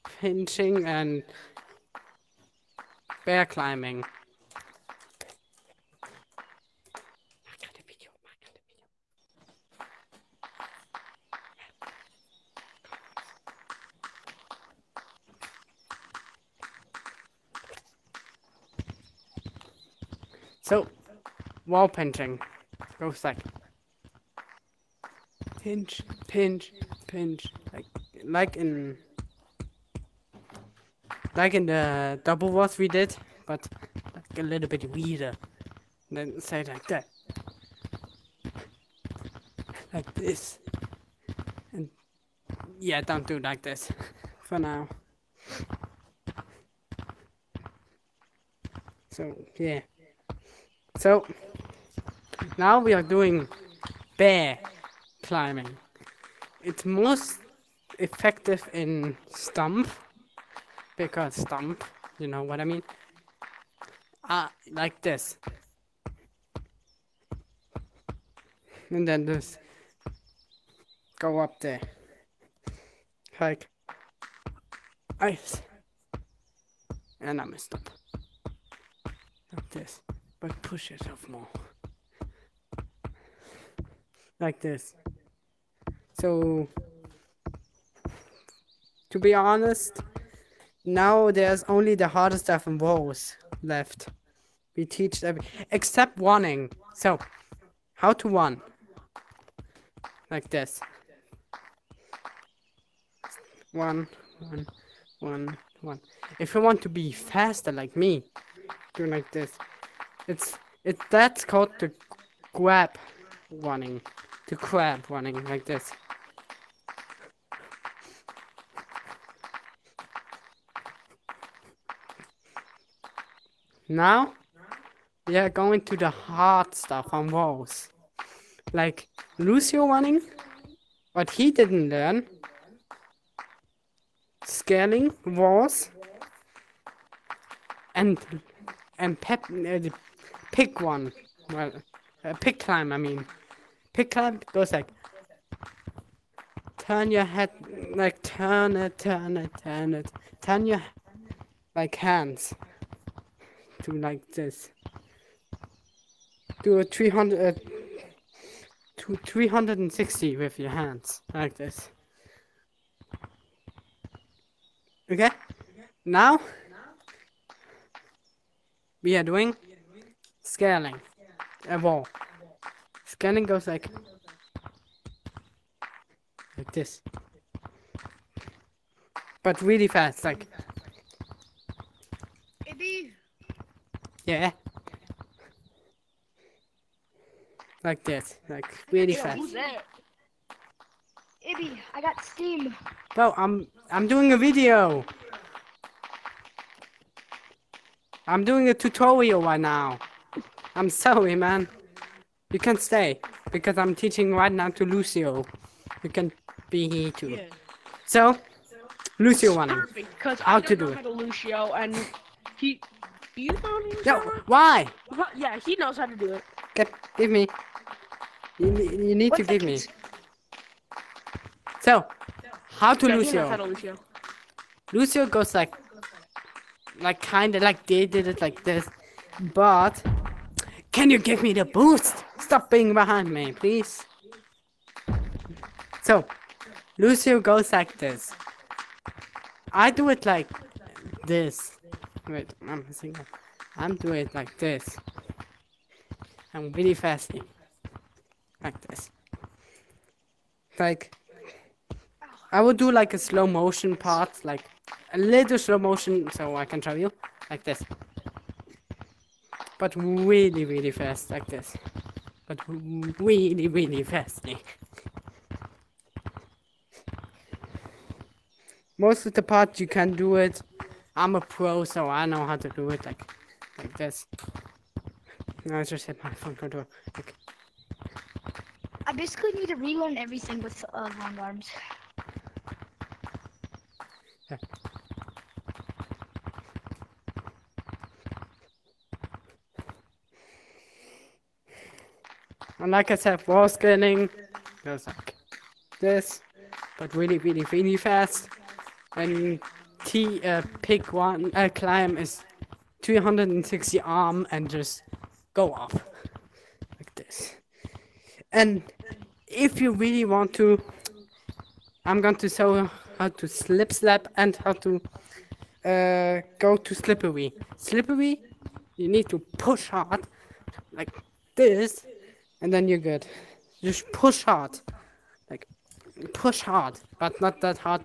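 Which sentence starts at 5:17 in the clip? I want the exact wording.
Slippery, you need to push hard like this and then you're good.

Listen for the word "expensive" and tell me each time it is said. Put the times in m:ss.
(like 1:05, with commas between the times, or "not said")
not said.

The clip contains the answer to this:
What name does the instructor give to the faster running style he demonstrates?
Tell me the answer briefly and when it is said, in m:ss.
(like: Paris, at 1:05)
Crab running, at 1:54.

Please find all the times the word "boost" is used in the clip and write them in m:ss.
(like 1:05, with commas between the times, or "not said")
3:51.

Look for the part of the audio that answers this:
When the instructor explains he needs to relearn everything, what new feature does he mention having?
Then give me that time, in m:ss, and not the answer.
4:41.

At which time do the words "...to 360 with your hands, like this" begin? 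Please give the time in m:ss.
2:38.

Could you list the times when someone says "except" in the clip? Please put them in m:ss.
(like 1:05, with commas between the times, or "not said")
1:35.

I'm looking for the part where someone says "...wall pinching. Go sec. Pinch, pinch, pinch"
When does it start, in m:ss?
0:21.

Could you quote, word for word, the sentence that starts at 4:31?
I'm a pro, so I know how to do it like, like this.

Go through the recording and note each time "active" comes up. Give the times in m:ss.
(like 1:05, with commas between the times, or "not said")
not said.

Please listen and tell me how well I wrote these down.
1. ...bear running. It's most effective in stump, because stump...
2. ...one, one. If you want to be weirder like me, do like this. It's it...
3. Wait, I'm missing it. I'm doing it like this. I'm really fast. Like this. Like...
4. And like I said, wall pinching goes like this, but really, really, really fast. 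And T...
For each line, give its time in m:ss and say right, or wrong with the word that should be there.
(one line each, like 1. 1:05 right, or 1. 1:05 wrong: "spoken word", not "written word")
1. 0:54 wrong: "climbing", not "running"
2. 1:45 wrong: "faster", not "weirder"
3. 4:02 right
4. 4:52 wrong: "scaling", not "pinching".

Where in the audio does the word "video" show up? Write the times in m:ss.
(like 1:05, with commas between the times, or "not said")
3:14.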